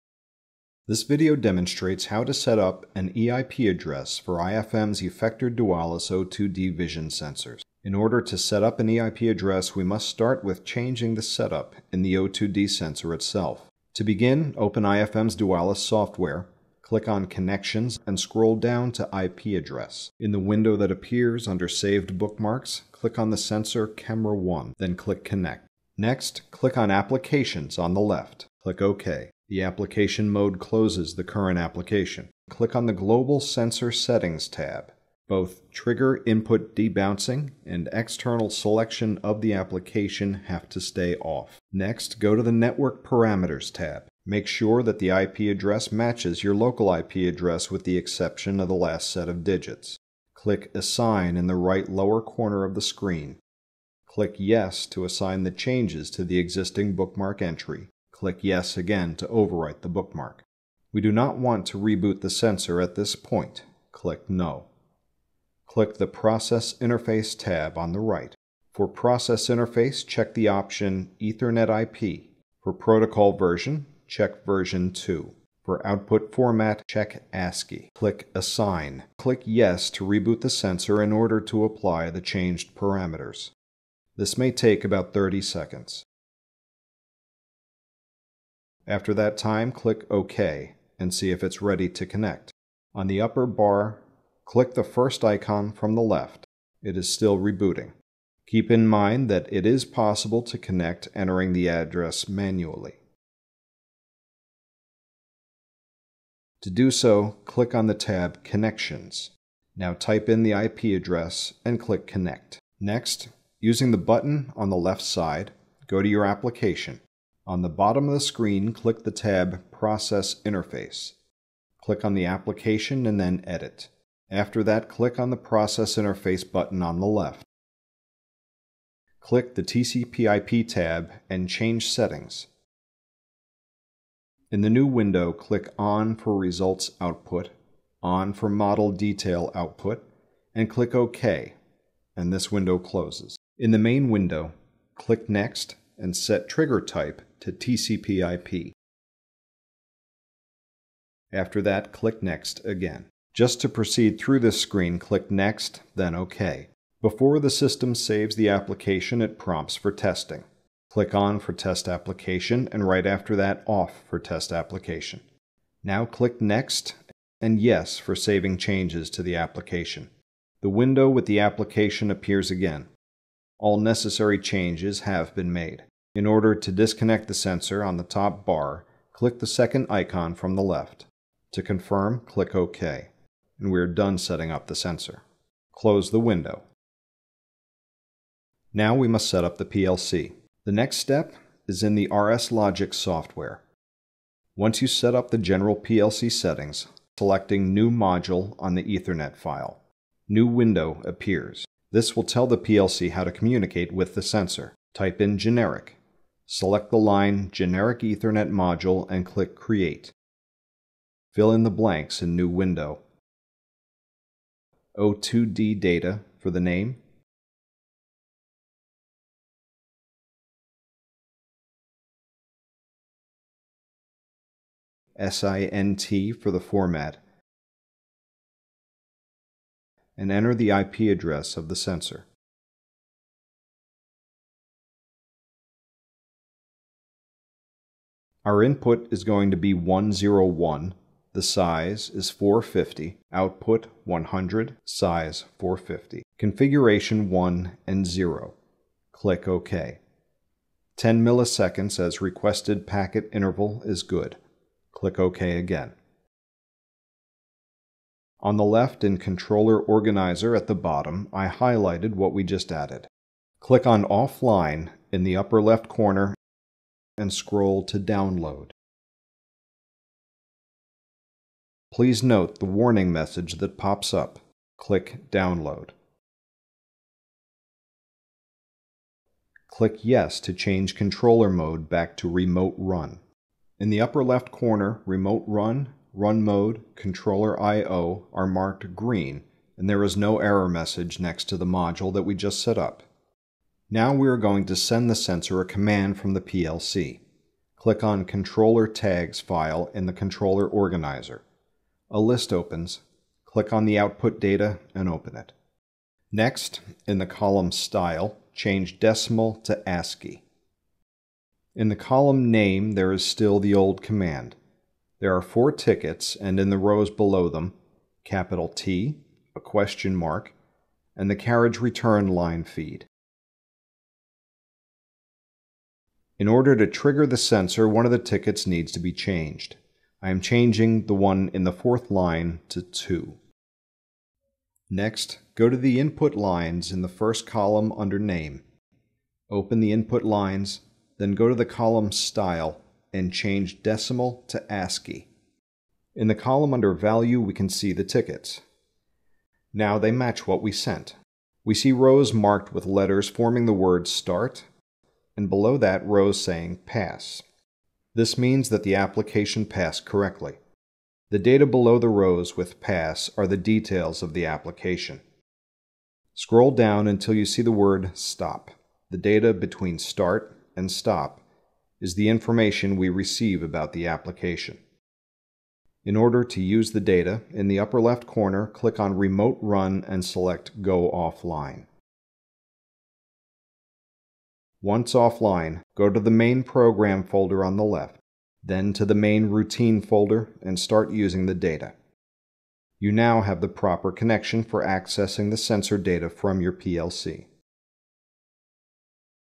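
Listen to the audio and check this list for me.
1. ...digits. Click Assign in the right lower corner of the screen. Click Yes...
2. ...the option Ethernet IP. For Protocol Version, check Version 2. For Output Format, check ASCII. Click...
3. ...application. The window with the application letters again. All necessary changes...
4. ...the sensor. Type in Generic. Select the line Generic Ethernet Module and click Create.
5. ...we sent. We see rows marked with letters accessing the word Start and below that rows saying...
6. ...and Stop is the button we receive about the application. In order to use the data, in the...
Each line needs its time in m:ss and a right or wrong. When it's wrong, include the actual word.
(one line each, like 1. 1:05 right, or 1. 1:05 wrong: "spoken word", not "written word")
1. 0:49 right
2. 1:10 right
3. 2:49 wrong: "appears", not "letters"
4. 3:24 right
5. 5:50 wrong: "forming", not "accessing"
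6. 6:10 wrong: "information", not "button".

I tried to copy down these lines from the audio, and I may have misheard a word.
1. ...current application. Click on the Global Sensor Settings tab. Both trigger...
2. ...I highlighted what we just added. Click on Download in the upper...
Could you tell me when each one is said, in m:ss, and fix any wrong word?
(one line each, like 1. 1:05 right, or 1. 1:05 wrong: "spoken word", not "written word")
1. 0:31 right
2. 4:21 wrong: "Offline", not "Download".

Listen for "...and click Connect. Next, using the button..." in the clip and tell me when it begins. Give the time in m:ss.
1:51.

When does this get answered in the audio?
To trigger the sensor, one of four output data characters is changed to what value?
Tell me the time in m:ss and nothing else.
5:32.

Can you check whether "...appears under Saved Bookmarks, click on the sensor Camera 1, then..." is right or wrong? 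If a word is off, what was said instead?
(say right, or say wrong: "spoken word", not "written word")
right.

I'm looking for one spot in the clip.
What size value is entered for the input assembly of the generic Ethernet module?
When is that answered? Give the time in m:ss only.
4:01.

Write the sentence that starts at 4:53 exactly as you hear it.
Now we are going to send the sensor a command from the PLC.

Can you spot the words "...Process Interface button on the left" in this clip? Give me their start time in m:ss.
2:05.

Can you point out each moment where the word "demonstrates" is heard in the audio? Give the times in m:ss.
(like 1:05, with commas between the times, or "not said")
0:01.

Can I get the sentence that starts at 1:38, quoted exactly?
Keep in mind that it is possible to connect entering the address manually.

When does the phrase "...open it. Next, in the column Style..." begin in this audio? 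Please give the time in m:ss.
5:05.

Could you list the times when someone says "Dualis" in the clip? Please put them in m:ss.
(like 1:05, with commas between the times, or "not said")
0:05, 0:15.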